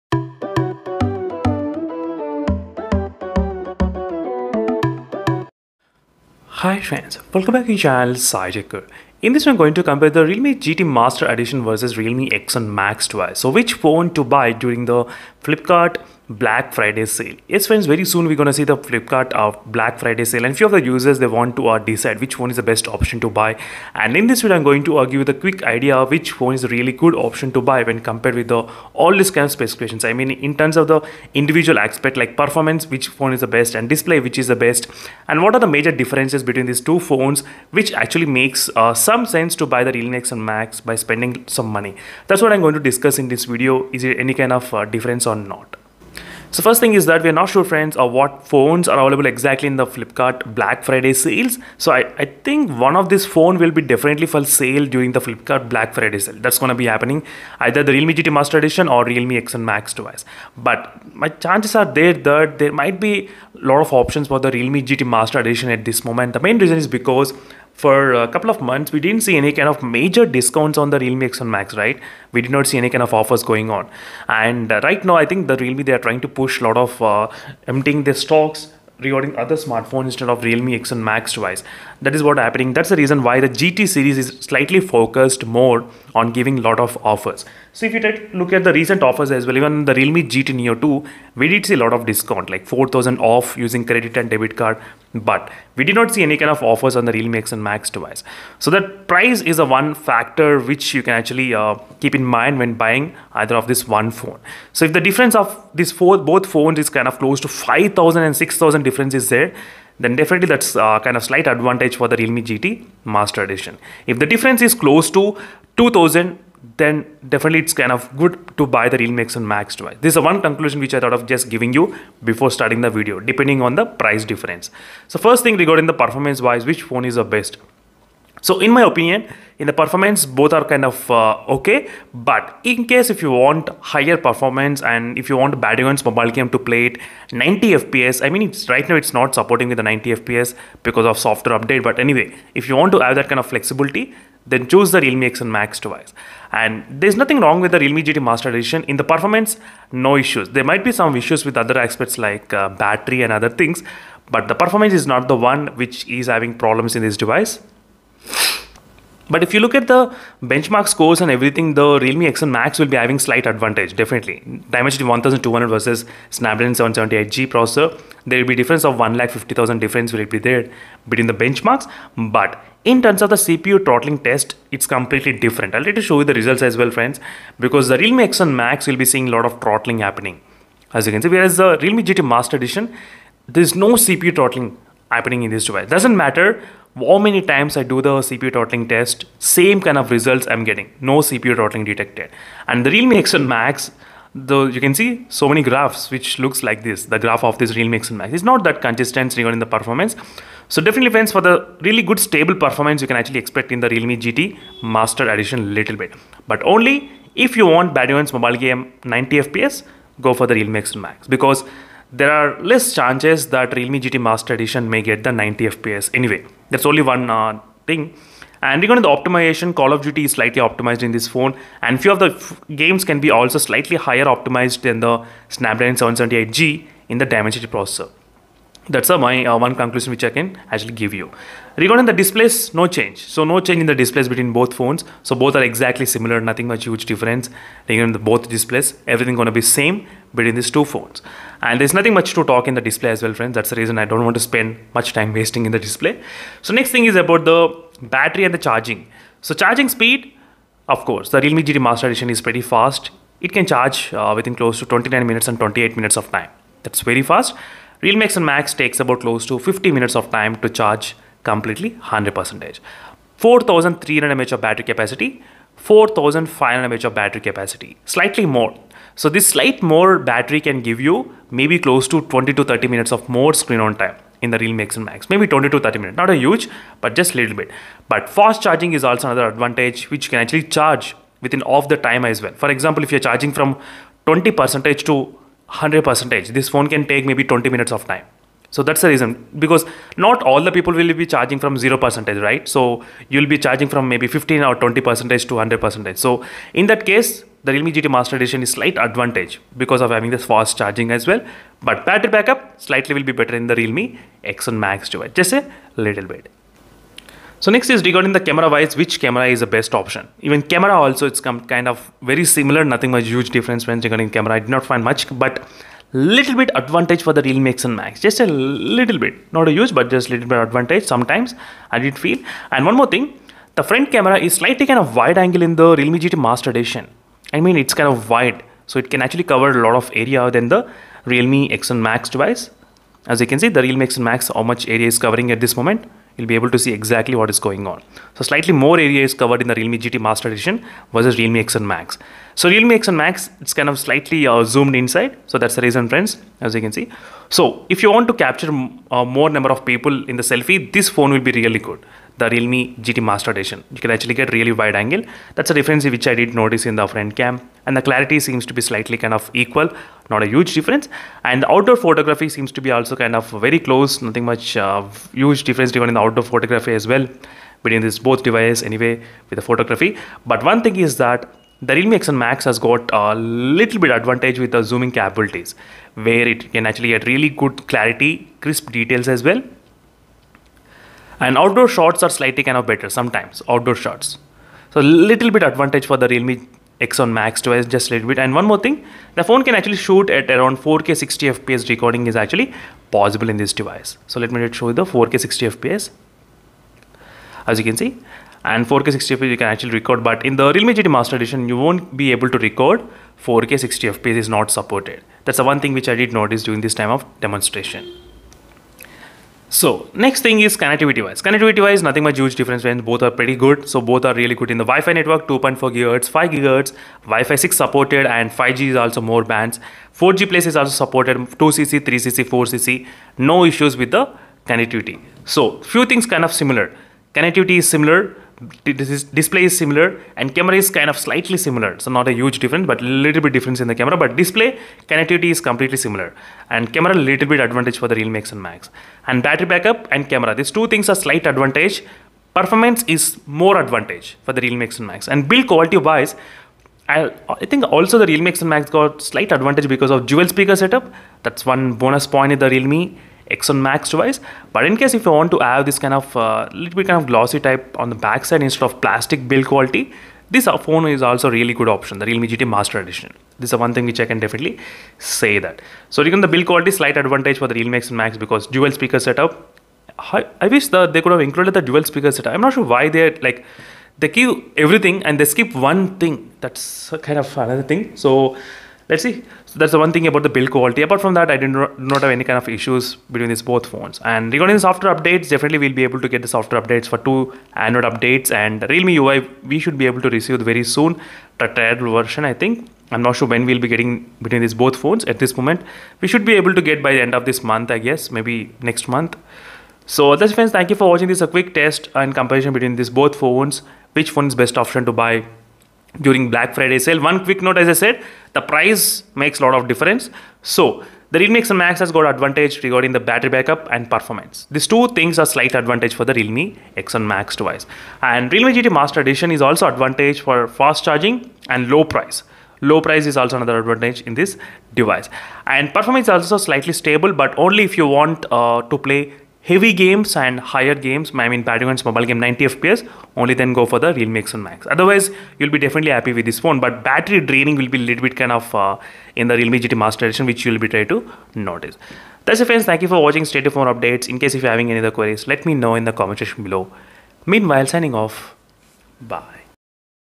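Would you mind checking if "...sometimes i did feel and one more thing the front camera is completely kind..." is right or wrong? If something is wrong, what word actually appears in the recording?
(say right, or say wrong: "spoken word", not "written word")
wrong: "slightly", not "completely".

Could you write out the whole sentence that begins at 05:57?
And the clarity seems to be slightly kind of equal, not a huge difference.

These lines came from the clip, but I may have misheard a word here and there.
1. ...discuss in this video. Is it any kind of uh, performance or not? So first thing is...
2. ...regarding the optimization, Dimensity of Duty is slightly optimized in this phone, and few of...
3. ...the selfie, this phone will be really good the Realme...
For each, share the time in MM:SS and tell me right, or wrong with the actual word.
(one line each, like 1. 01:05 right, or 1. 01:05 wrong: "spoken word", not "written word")
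1. 00:42 wrong: "difference", not "performance"
2. 03:38 wrong: "Call", not "Dimensity"
3. 05:50 right.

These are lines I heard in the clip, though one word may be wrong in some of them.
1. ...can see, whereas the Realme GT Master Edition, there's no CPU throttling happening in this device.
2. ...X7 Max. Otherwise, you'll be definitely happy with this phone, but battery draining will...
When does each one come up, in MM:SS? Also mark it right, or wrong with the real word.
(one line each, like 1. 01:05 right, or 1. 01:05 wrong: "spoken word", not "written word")
1. 03:01 right
2. 08:54 right.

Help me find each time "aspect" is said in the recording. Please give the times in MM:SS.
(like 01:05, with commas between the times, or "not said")
00:31, 02:31.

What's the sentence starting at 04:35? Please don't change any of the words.
Maybe 20 to 30 minutes, not a huge, but just little bit.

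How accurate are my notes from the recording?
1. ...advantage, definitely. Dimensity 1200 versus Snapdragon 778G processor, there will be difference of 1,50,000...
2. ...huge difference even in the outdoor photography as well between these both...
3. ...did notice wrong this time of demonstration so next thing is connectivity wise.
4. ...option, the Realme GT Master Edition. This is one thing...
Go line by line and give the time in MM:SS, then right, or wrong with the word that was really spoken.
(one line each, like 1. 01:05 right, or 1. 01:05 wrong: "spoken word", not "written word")
1. 02:43 right
2. 06:05 right
3. 06:46 wrong: "during", not "wrong"
4. 07:41 right.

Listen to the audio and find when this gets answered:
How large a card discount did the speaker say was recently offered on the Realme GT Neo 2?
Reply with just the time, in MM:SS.
01:32.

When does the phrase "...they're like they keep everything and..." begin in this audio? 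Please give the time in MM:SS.
07:53.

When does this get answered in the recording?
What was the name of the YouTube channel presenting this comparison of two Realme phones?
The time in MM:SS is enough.
00:08.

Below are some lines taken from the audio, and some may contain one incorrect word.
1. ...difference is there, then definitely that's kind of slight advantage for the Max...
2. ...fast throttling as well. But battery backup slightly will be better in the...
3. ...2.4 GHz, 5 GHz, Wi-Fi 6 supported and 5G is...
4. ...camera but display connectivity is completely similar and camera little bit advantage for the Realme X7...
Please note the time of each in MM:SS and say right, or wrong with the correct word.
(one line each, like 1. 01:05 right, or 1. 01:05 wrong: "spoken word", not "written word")
1. 01:48 wrong: "Realme", not "Max"
2. 05:00 wrong: "charging", not "throttling"
3. 06:55 right
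4. 07:13 right.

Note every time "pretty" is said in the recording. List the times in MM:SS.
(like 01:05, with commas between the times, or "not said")
04:12, 06:53.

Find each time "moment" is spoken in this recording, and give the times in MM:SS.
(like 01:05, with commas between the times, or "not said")
01:06, 05:35, 08:15.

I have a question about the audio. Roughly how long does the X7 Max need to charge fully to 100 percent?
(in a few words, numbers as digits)
50 minutes.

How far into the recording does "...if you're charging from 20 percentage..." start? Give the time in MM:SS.
04:43.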